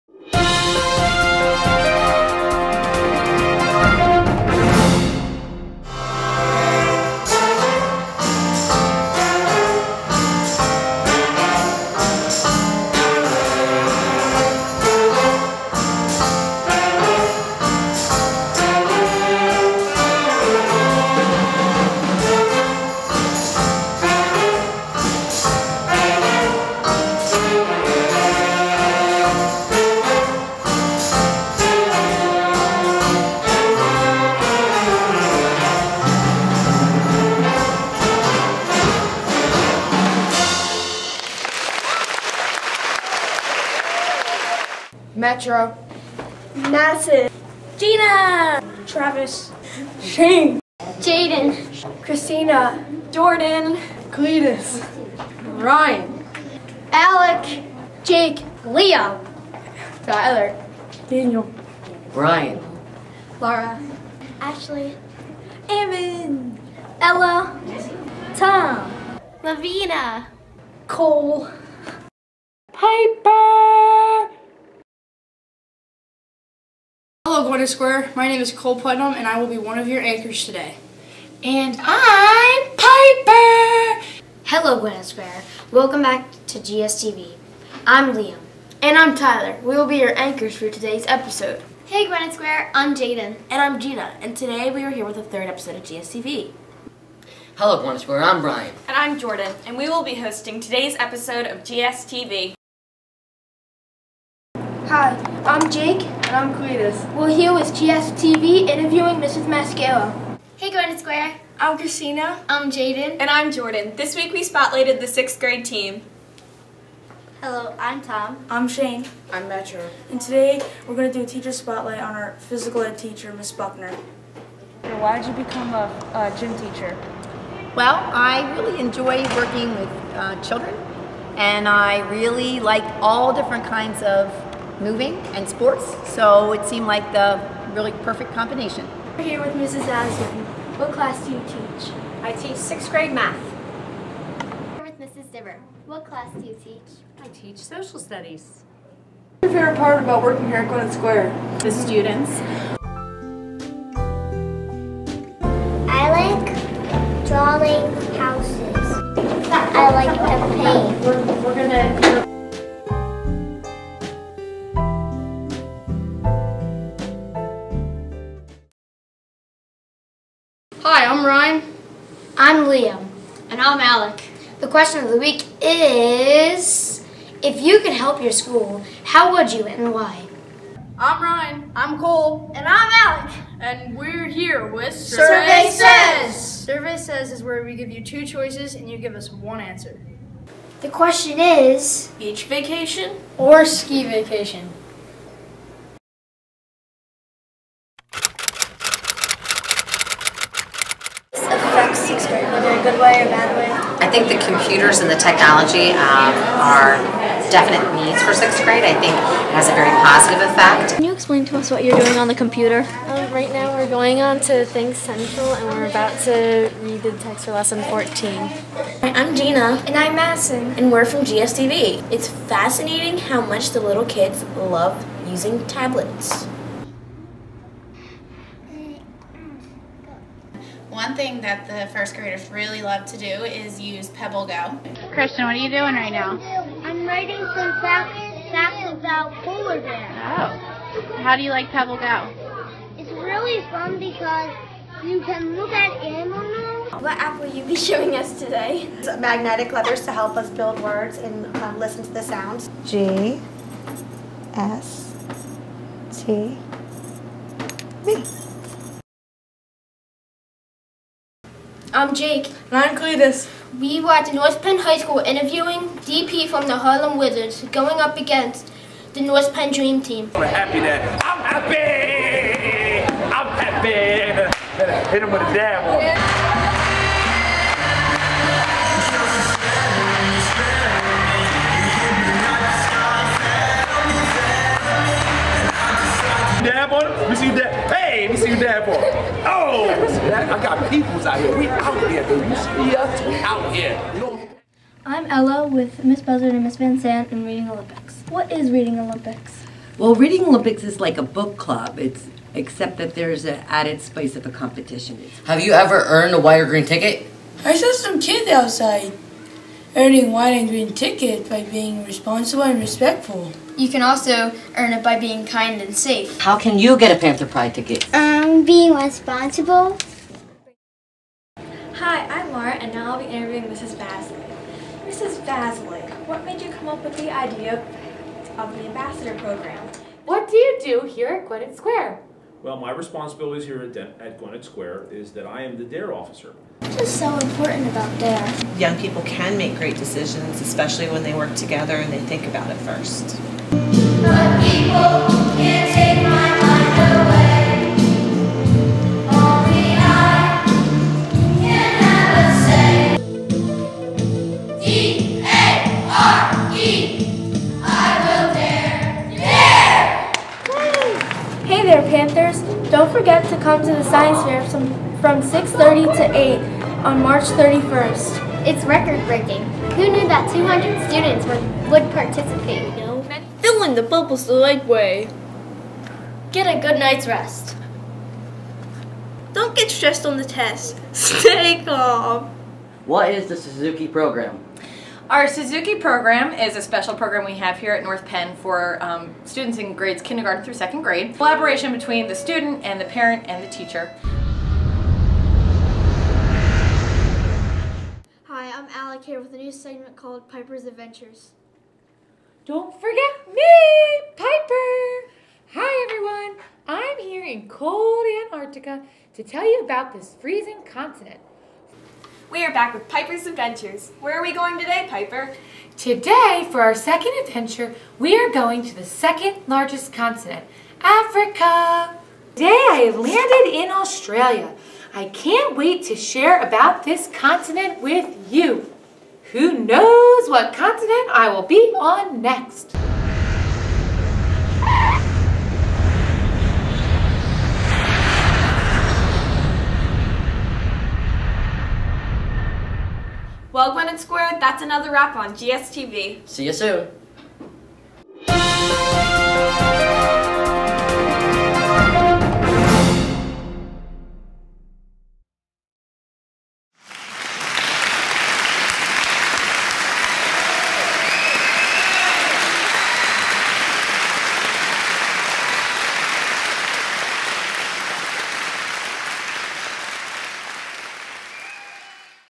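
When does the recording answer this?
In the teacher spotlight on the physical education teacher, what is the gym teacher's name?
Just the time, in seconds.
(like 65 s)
123 s.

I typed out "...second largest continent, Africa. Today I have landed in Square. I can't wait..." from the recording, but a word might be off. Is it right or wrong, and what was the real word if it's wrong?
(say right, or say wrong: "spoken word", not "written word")
wrong: "Australia", not "Square".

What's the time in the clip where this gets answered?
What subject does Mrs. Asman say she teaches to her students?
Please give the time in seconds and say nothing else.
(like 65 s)
142 s.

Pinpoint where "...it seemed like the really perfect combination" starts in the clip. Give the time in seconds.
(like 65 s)
136 s.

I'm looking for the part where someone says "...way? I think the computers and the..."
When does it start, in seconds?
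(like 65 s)
203 s.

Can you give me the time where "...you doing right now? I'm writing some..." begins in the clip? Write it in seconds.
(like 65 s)
235 s.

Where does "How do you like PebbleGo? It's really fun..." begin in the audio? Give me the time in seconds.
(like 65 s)
241 s.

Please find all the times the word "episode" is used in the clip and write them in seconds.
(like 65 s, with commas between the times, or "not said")
91 s, 95 s, 100 s.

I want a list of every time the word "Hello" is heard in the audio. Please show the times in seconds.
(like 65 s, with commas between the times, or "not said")
84 s, 97 s, 117 s.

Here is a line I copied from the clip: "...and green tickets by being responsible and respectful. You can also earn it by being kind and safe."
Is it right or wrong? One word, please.
right.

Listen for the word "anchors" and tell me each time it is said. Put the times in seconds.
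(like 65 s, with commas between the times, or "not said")
80 s, 90 s.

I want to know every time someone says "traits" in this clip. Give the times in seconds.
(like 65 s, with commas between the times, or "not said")
not said.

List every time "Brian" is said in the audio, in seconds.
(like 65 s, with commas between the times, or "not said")
62 s, 98 s.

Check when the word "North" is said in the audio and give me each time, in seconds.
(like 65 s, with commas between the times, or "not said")
264 s, 269 s, 388 s.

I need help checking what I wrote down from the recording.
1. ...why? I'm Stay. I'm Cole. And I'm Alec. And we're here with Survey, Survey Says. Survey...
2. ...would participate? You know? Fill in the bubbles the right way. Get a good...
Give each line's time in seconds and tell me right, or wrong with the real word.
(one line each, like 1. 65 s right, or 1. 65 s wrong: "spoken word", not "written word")
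1. 179 s wrong: "Ryan", not "Stay"
2. 371 s right.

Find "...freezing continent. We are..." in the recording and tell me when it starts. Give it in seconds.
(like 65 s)
410 s.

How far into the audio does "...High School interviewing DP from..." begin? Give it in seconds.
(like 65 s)
264 s.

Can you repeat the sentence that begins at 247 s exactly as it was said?
What app will you be showing us today?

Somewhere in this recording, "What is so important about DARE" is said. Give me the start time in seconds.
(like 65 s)
336 s.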